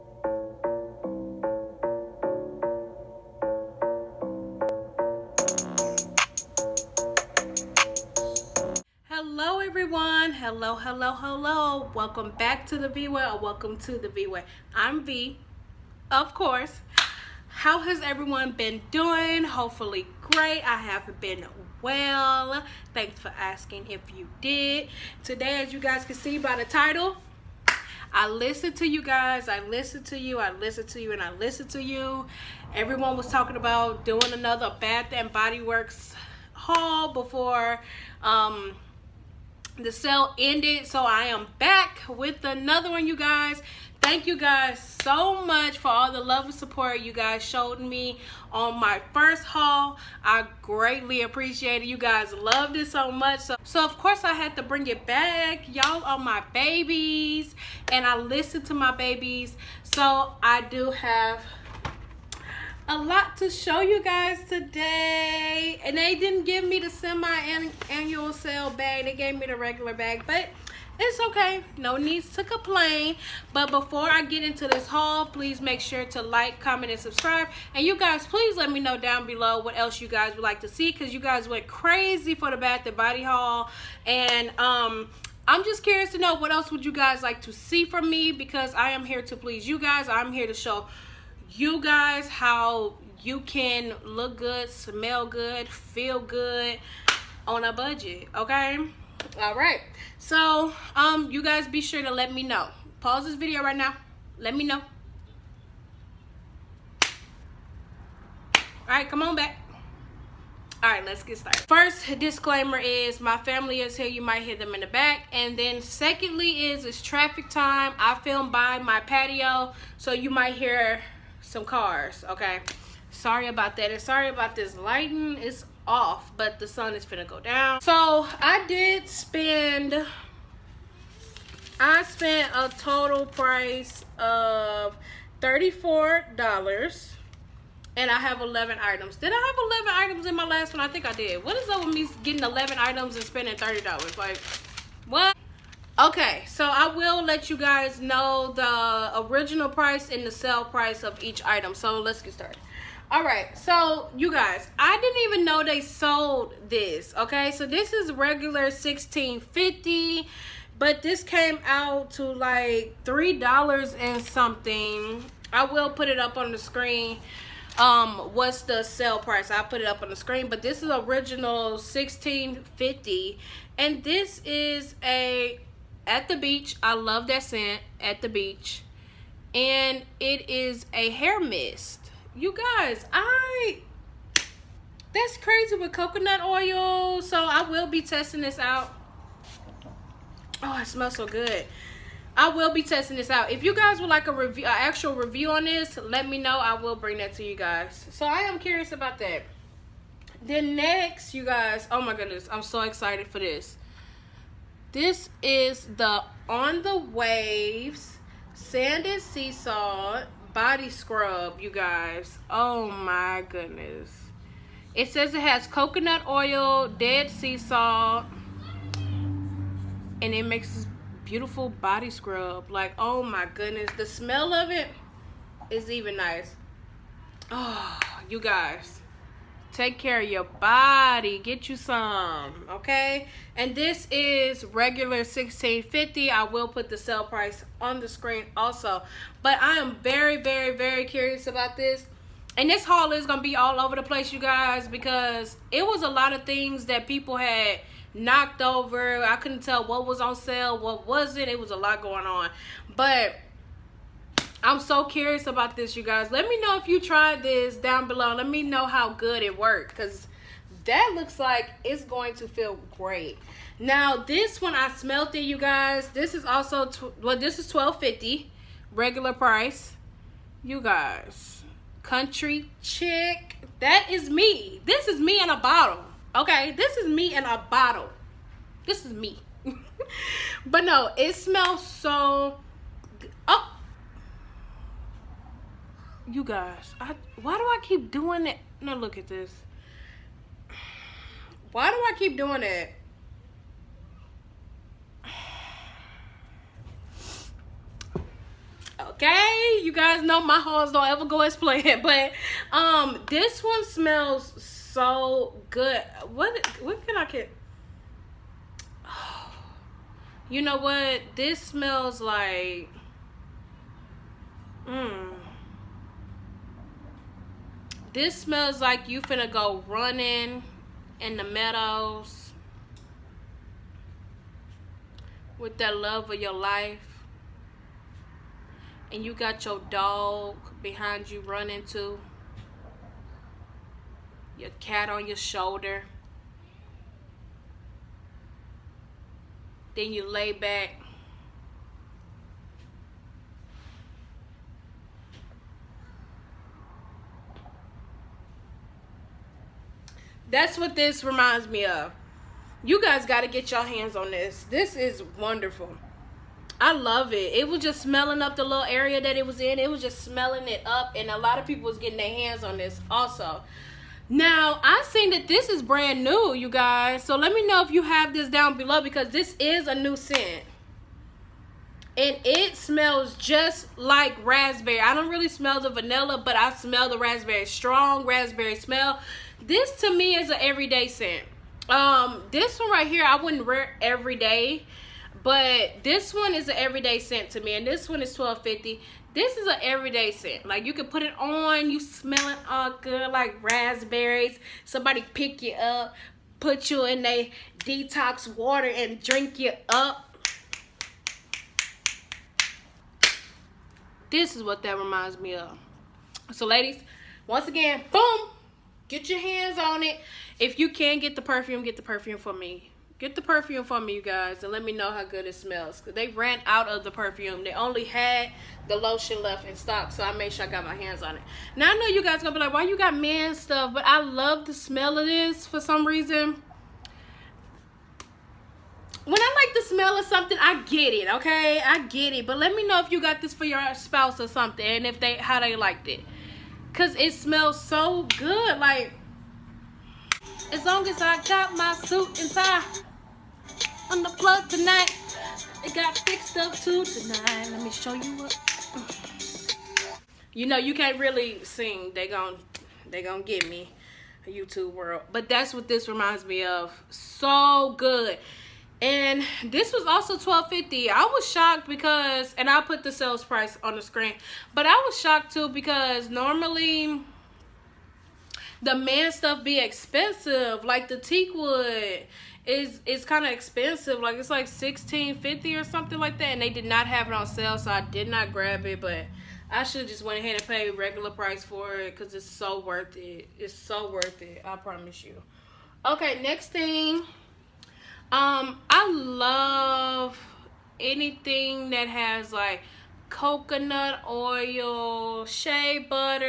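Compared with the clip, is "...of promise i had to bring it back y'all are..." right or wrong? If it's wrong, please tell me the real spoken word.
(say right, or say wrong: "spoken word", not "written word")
wrong: "course", not "promise".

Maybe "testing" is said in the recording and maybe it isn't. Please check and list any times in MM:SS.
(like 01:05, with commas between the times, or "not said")
03:08, 03:12.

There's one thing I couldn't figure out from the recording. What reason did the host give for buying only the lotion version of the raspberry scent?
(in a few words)
They ran out of the perfume.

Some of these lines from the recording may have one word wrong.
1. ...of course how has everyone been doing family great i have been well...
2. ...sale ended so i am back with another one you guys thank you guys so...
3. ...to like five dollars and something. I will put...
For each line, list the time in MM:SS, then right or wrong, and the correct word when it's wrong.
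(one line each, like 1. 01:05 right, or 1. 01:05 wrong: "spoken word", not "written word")
1. 00:16 wrong: "hopefully", not "family"
2. 00:39 right
3. 02:42 wrong: "three", not "five".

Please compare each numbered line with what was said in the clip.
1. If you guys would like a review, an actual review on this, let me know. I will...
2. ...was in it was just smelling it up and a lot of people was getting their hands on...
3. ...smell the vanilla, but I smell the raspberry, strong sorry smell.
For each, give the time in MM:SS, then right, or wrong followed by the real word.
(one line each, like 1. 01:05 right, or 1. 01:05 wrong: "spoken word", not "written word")
1. 03:13 right
2. 05:59 right
3. 06:15 wrong: "raspberry", not "sorry".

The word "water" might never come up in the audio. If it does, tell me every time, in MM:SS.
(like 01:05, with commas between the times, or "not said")
06:38.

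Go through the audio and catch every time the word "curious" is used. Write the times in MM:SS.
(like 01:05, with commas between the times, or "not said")
01:25, 03:18, 04:01, 04:15.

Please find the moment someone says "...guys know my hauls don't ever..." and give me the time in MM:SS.
04:59.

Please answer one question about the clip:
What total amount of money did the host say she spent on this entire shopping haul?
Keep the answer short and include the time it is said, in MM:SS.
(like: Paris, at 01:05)
$34, at 02:15.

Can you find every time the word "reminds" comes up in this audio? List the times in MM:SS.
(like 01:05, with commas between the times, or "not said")
05:51, 06:44, 07:36.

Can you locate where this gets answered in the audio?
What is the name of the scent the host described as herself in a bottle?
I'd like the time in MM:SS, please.
04:32.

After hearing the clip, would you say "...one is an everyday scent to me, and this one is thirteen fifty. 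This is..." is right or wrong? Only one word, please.
wrong.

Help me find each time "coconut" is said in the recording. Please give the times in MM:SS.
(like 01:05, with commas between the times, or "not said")
03:05, 03:35, 08:13.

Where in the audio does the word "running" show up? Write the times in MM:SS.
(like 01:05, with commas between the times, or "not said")
05:19, 05:31.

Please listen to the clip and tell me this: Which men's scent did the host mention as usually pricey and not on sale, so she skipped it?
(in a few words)
Teakwood.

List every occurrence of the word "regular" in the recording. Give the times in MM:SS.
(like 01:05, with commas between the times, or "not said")
01:09, 02:38, 03:54, 04:28, 08:00.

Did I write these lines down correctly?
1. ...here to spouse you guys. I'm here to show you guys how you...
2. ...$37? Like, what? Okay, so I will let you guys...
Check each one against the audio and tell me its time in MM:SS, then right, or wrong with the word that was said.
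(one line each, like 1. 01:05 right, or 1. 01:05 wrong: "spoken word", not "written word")
1. 01:29 wrong: "please", not "spouse"
2. 02:23 wrong: "30", not "37".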